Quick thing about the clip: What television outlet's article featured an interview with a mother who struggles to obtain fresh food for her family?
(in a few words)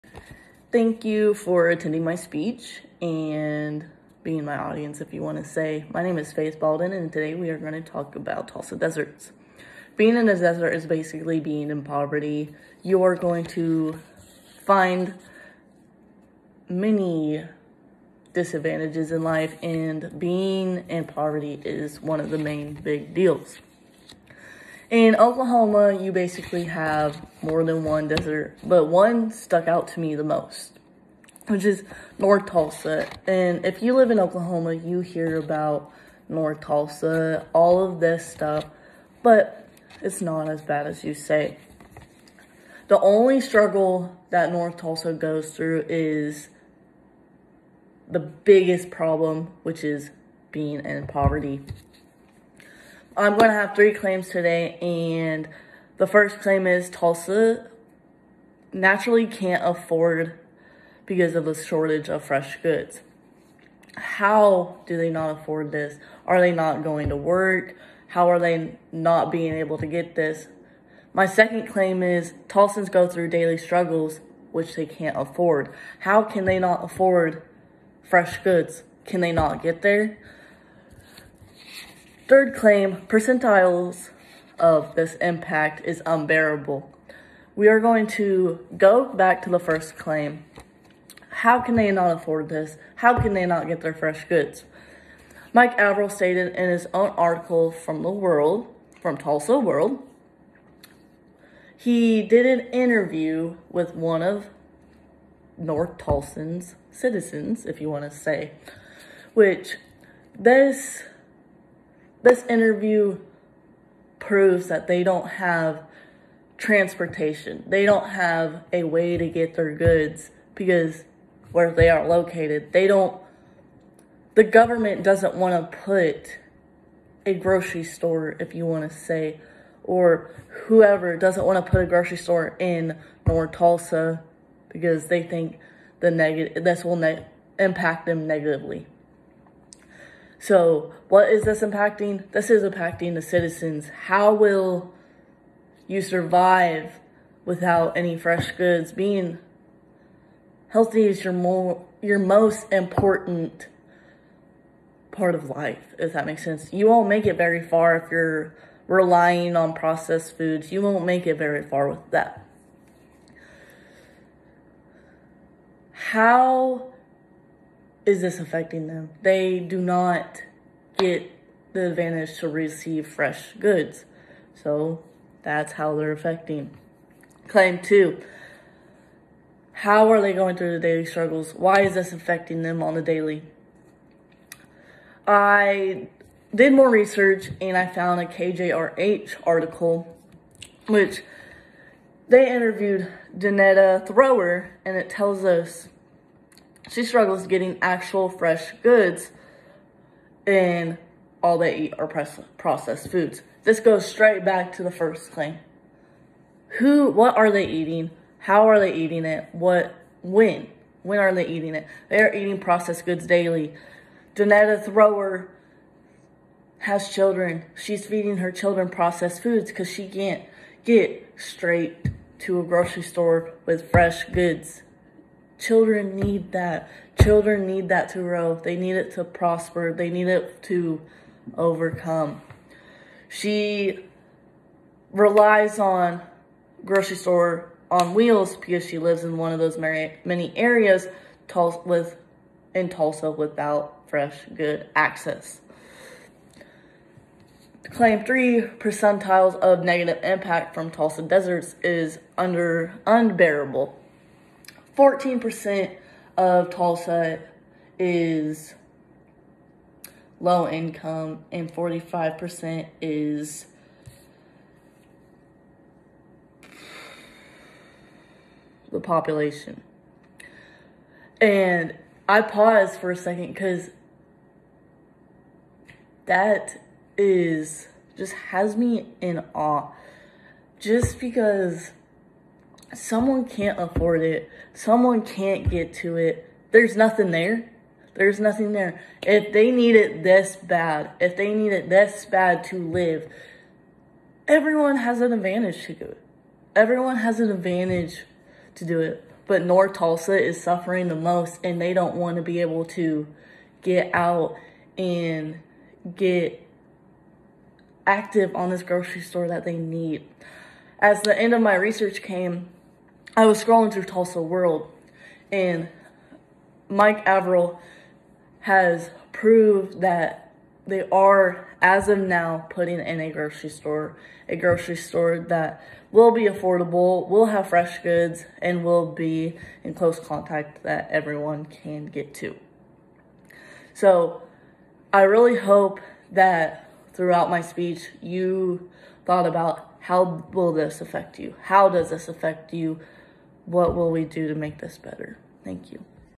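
KJRH.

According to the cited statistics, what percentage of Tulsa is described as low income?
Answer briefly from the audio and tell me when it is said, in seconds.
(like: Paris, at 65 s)
14%, at 254 s.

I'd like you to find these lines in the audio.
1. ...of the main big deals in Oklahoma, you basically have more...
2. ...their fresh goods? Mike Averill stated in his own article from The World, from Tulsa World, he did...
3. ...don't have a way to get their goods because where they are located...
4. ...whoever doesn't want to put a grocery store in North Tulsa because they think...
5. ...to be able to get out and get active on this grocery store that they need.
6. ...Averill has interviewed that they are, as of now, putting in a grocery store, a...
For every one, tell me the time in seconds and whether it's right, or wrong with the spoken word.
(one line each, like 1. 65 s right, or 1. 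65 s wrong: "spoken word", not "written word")
1. 22 s right
2. 93 s right
3. 117 s right
4. 130 s right
5. 302 s right
6. 317 s wrong: "proved", not "interviewed".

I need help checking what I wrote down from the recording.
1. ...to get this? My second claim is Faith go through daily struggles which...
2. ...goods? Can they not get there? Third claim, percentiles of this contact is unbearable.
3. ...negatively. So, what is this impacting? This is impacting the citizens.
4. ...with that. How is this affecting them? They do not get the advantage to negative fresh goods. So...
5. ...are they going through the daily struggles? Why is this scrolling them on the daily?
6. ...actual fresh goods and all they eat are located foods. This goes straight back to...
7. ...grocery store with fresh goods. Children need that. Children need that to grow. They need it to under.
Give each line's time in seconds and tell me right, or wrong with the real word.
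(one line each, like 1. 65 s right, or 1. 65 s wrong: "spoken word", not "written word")
1. 69 s wrong: "Tulsans", not "Faith"
2. 78 s wrong: "impact", not "contact"
3. 138 s right
4. 161 s wrong: "receive", not "negative"
5. 180 s wrong: "affecting", not "scrolling"
6. 197 s wrong: "processed", not "located"
7. 222 s wrong: "prosper", not "under".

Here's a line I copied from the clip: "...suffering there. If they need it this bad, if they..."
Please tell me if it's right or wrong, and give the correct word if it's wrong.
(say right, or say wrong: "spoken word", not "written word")
wrong: "nothing", not "suffering".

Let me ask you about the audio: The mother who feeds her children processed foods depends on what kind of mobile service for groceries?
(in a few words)
grocery store on wheels.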